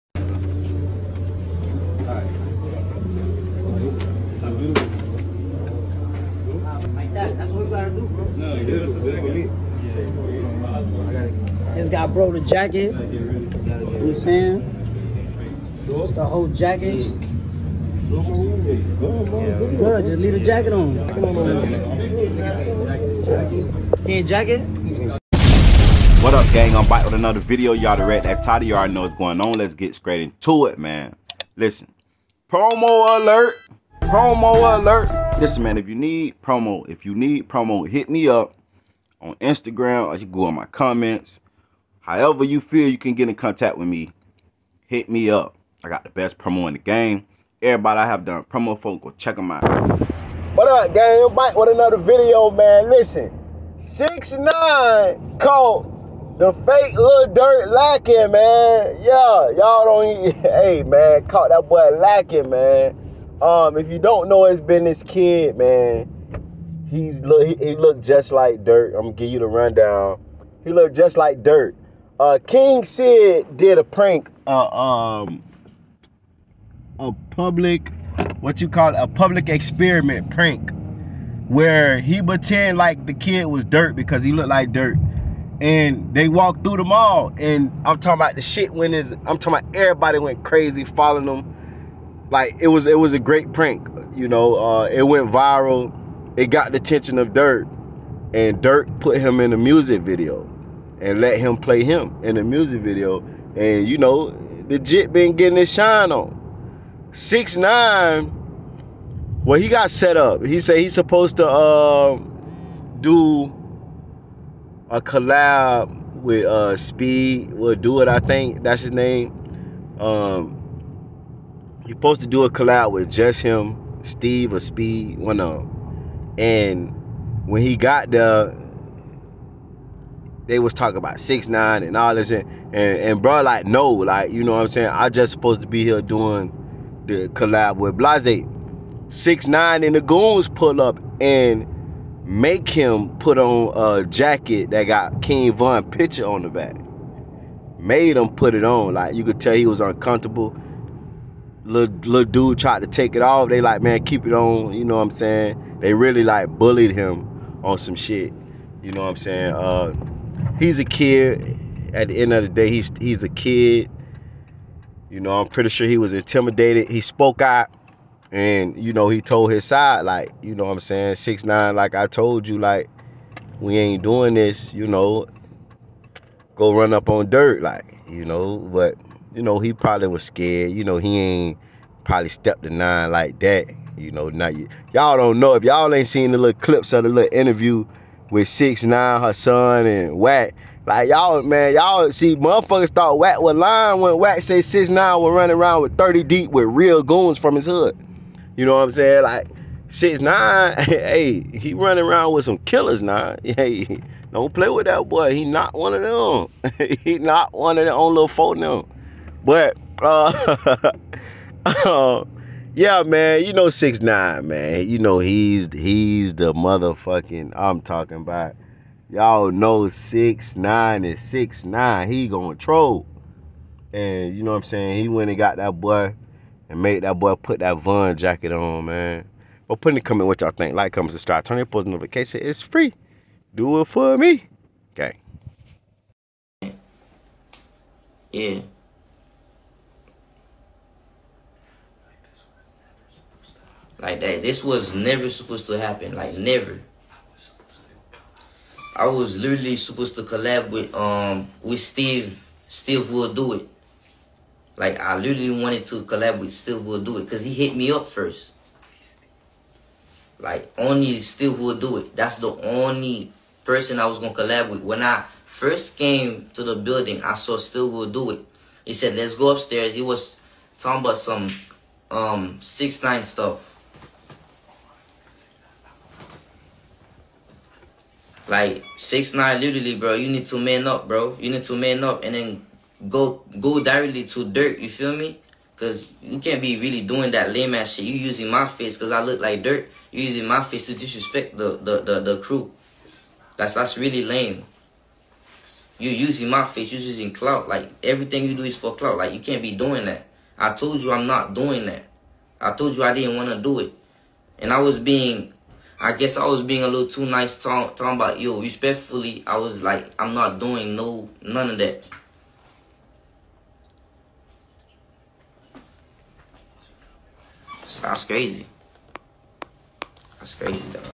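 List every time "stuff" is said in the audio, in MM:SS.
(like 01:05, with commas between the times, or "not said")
04:33.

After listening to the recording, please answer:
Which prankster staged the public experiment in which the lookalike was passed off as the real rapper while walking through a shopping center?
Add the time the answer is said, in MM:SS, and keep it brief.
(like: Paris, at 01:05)
King Sid, at 01:12.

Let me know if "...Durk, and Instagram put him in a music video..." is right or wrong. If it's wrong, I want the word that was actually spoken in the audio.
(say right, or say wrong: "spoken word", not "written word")
wrong: "Durk", not "Instagram".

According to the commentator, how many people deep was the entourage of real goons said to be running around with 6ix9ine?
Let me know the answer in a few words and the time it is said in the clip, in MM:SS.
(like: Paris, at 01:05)
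30, at 03:15.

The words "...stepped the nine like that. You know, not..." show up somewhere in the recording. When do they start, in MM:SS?
03:02.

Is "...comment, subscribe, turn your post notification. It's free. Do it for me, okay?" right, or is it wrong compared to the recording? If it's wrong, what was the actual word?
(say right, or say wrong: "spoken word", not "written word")
right.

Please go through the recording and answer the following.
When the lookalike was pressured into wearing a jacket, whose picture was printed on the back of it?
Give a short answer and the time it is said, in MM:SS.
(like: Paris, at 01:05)
King Von, at 02:25.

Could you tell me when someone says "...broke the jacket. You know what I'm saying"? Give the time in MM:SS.
00:12.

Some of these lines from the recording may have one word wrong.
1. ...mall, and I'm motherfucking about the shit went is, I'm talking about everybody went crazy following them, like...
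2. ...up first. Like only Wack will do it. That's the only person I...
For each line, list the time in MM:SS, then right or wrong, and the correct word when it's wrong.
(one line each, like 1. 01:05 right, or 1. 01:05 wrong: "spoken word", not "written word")
1. 01:26 wrong: "talking", not "motherfucking"
2. 04:17 wrong: "Steve", not "Wack".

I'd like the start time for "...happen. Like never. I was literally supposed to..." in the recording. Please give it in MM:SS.
04:05.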